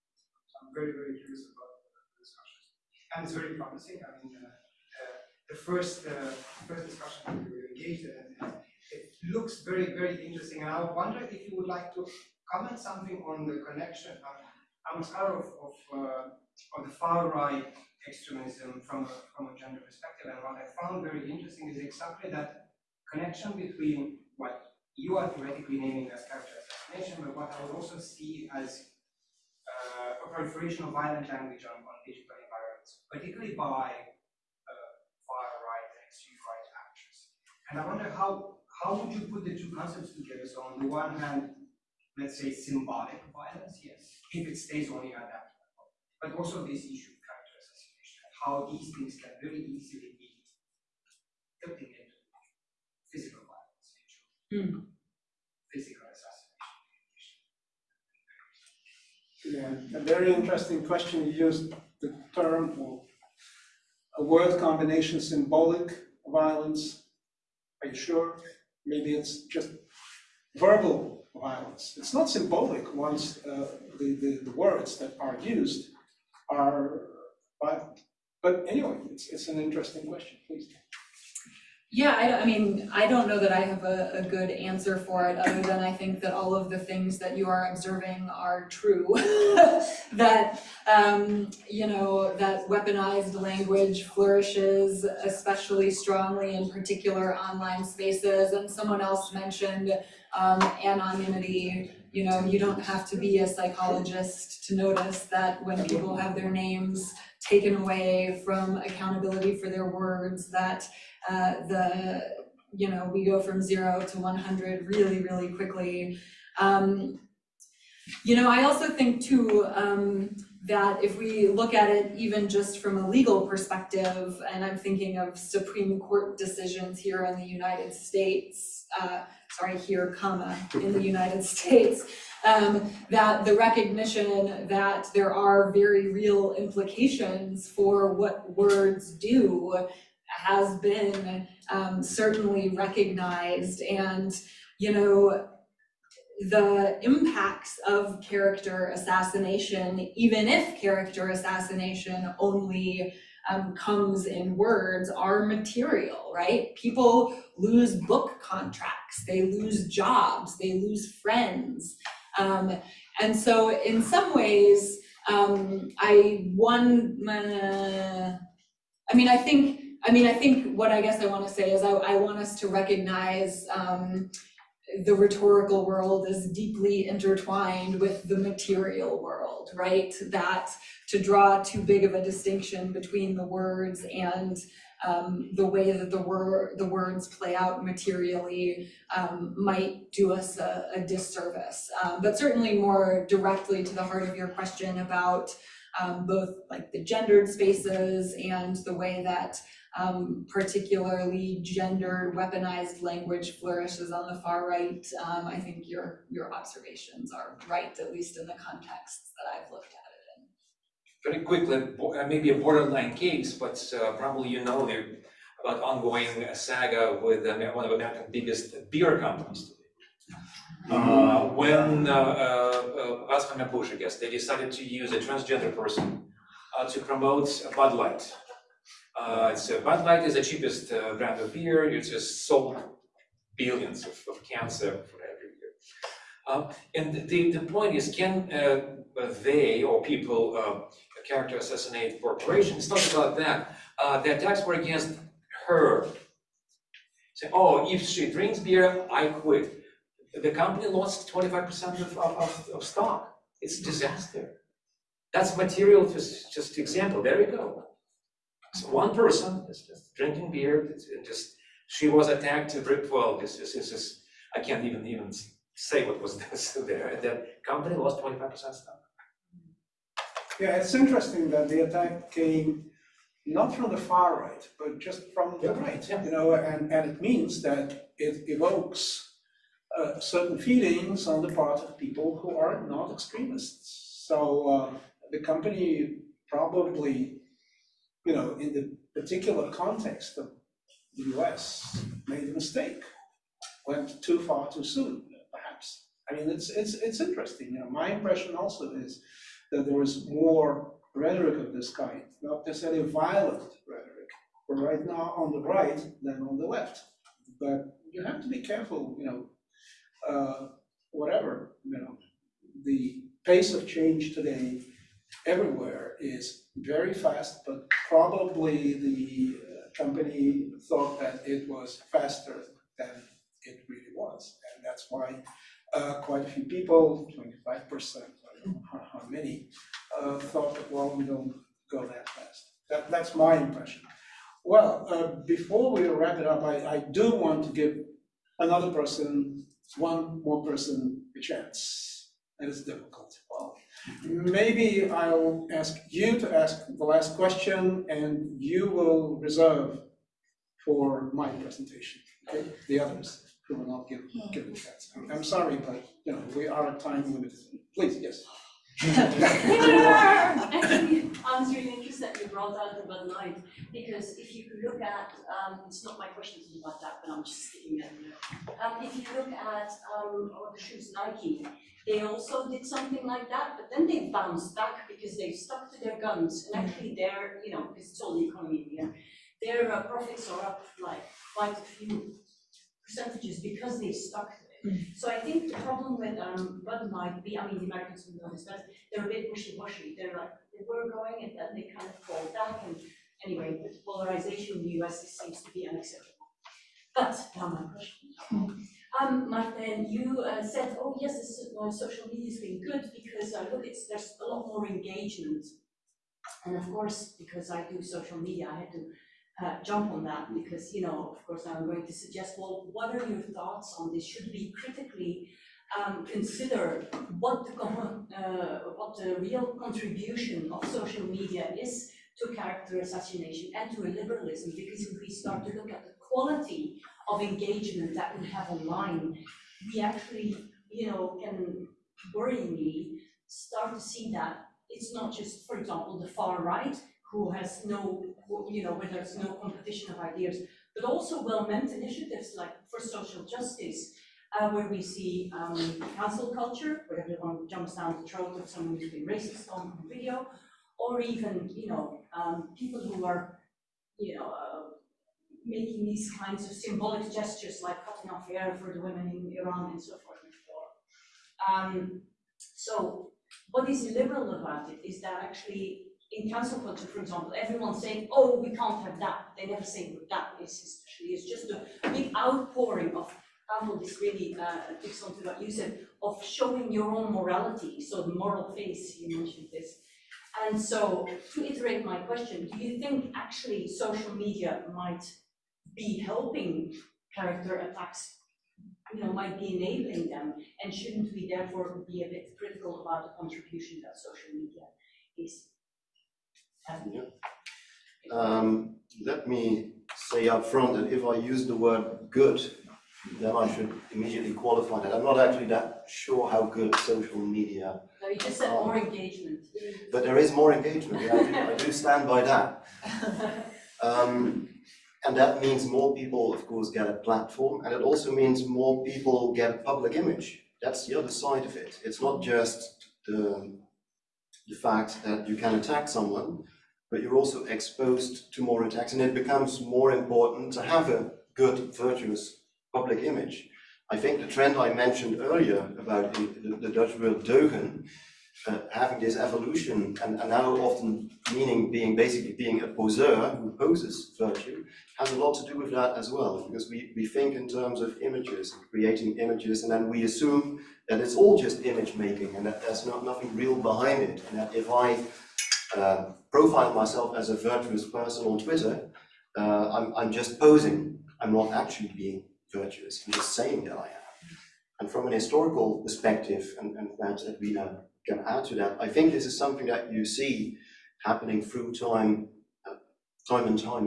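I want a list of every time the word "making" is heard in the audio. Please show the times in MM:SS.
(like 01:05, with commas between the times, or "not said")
07:35, 09:12.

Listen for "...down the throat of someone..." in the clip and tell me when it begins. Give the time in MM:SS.
07:27.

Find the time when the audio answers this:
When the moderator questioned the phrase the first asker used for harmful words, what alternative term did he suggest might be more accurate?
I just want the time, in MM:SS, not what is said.
01:10.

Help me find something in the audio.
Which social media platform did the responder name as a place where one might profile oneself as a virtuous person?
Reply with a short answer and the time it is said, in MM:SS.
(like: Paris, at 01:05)
Twitter, at 09:18.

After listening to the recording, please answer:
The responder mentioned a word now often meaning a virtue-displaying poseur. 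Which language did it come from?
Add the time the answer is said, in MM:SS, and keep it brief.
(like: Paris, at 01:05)
Dutch, at 08:56.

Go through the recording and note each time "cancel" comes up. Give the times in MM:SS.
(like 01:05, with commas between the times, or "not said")
07:26, 07:46.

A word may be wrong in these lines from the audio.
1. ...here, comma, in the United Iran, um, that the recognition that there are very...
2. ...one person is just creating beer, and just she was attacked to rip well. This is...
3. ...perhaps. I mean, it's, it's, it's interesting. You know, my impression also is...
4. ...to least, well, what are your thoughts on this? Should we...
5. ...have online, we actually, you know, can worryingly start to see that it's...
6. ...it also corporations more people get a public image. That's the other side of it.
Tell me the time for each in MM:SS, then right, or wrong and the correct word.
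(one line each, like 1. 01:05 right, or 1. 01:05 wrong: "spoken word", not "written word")
1. 02:09 wrong: "States", not "Iran"
2. 04:18 wrong: "drinking", not "creating"
3. 04:55 right
4. 06:52 wrong: "suggest", not "least"
5. 07:08 right
6. 08:37 wrong: "means", not "corporations".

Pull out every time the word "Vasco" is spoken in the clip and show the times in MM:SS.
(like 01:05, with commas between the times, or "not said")
03:43.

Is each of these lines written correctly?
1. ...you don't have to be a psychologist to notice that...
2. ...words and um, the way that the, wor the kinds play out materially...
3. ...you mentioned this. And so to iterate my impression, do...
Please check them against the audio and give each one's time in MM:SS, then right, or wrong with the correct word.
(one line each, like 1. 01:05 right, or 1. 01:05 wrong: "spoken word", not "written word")
1. 01:42 right
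2. 03:03 wrong: "words", not "kinds"
3. 07:59 wrong: "question", not "impression".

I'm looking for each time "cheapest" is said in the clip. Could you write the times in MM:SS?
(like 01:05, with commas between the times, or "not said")
03:50.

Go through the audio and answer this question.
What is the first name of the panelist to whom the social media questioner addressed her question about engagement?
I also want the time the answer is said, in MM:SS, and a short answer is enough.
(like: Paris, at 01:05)
Martin, at 06:39.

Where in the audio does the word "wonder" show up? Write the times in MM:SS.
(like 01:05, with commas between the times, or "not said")
00:10, 00:37.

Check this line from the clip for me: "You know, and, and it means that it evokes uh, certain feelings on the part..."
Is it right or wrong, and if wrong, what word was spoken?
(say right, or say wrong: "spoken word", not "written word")
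right.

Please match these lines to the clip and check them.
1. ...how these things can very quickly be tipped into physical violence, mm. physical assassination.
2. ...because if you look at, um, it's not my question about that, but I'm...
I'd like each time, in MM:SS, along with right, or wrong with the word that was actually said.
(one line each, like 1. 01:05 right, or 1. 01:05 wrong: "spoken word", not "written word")
1. 00:48 wrong: "easily", not "quickly"
2. 06:03 right.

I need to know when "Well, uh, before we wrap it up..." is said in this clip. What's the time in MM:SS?
05:34.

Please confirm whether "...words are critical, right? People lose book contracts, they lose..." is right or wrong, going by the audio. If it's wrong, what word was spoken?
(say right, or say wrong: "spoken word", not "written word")
wrong: "material", not "critical".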